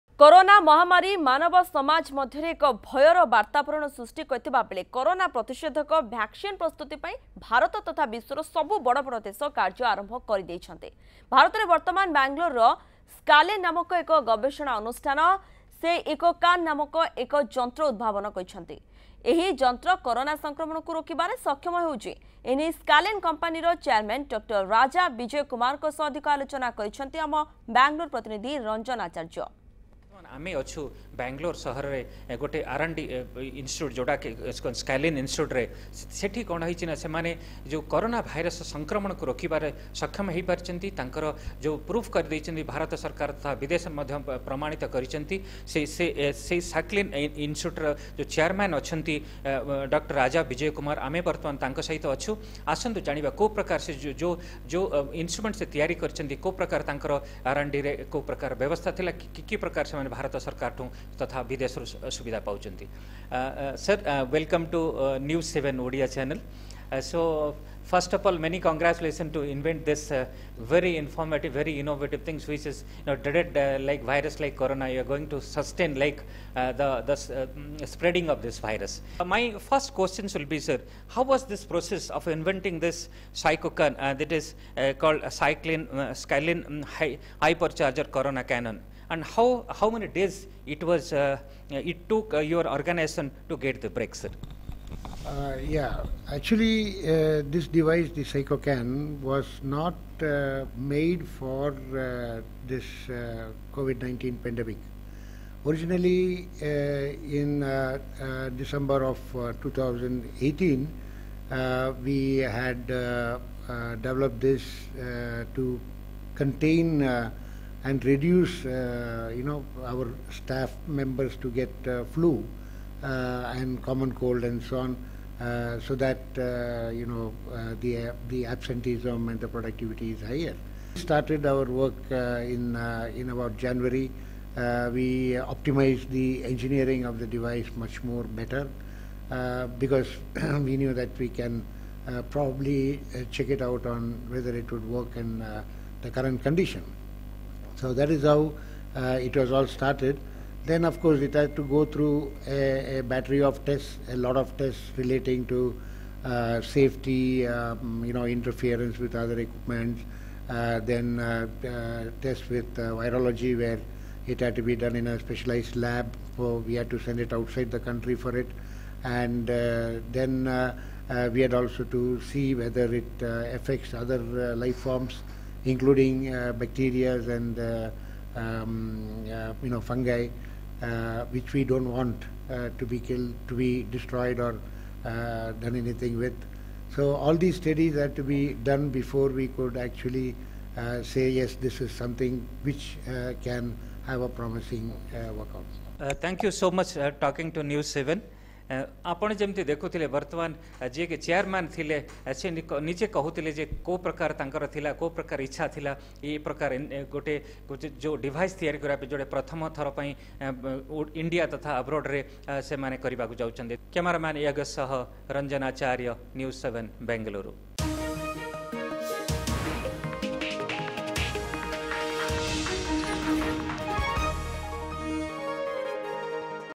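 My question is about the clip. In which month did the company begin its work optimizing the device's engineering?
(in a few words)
January.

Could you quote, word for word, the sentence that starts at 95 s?
Uh, yeah, actually, uh, this device, the Shycocan, was not uh, made for uh, this COVID 19 pandemic.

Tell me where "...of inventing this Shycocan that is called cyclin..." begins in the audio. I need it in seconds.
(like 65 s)
82 s.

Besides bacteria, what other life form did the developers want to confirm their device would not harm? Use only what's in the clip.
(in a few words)
fungi.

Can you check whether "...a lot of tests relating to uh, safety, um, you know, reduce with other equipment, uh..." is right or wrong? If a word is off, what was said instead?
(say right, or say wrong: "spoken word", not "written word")
wrong: "interference", not "reduce".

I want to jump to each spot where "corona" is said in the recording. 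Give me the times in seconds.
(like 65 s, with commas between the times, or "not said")
74 s, 88 s.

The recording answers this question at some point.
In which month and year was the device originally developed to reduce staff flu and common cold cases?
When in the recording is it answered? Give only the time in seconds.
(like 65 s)
108 s.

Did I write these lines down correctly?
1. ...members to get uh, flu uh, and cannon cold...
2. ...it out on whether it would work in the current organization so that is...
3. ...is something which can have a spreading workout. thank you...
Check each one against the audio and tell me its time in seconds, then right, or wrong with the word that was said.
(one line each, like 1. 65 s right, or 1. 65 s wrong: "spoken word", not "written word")
1. 120 s wrong: "common", not "cannon"
2. 143 s wrong: "condition", not "organization"
3. 191 s wrong: "promising", not "spreading".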